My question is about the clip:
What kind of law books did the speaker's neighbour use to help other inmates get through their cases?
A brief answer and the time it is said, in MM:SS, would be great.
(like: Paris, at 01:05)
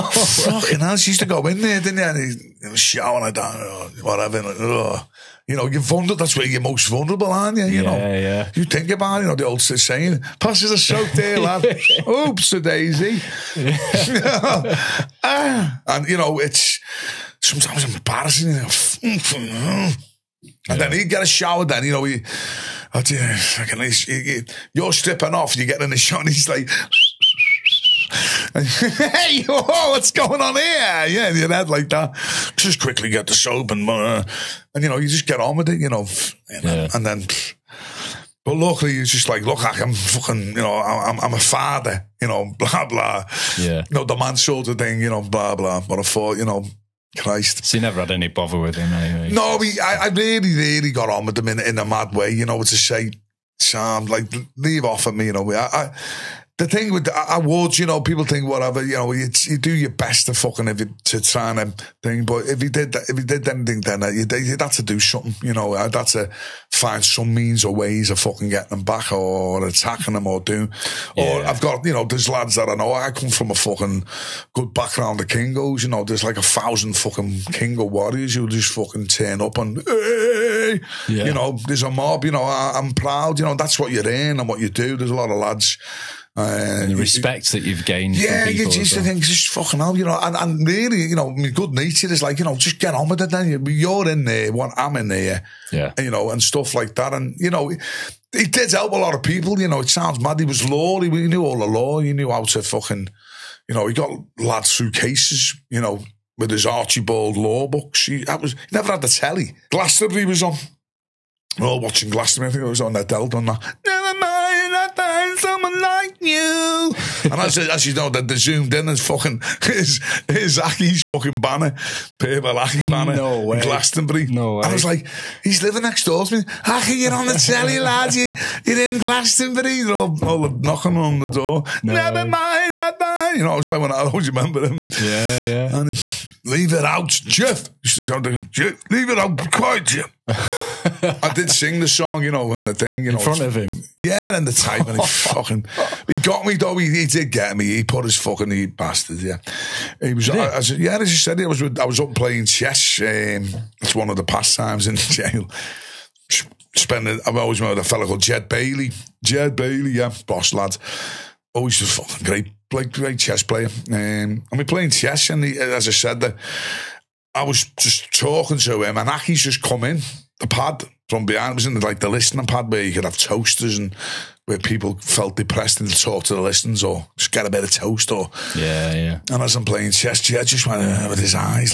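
Archbold, at 01:46.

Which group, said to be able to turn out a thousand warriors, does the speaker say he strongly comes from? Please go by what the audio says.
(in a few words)
Kingos.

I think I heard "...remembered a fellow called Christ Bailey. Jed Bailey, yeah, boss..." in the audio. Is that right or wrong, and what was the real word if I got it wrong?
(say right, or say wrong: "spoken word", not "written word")
wrong: "Jed", not "Christ".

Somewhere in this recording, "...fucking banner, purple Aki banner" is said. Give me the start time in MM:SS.
02:01.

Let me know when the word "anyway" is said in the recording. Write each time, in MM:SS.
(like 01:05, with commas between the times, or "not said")
00:48.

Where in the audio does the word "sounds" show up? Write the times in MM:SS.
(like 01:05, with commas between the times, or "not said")
01:39, 02:18.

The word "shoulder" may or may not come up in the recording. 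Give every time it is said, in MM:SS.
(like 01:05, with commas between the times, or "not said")
00:44.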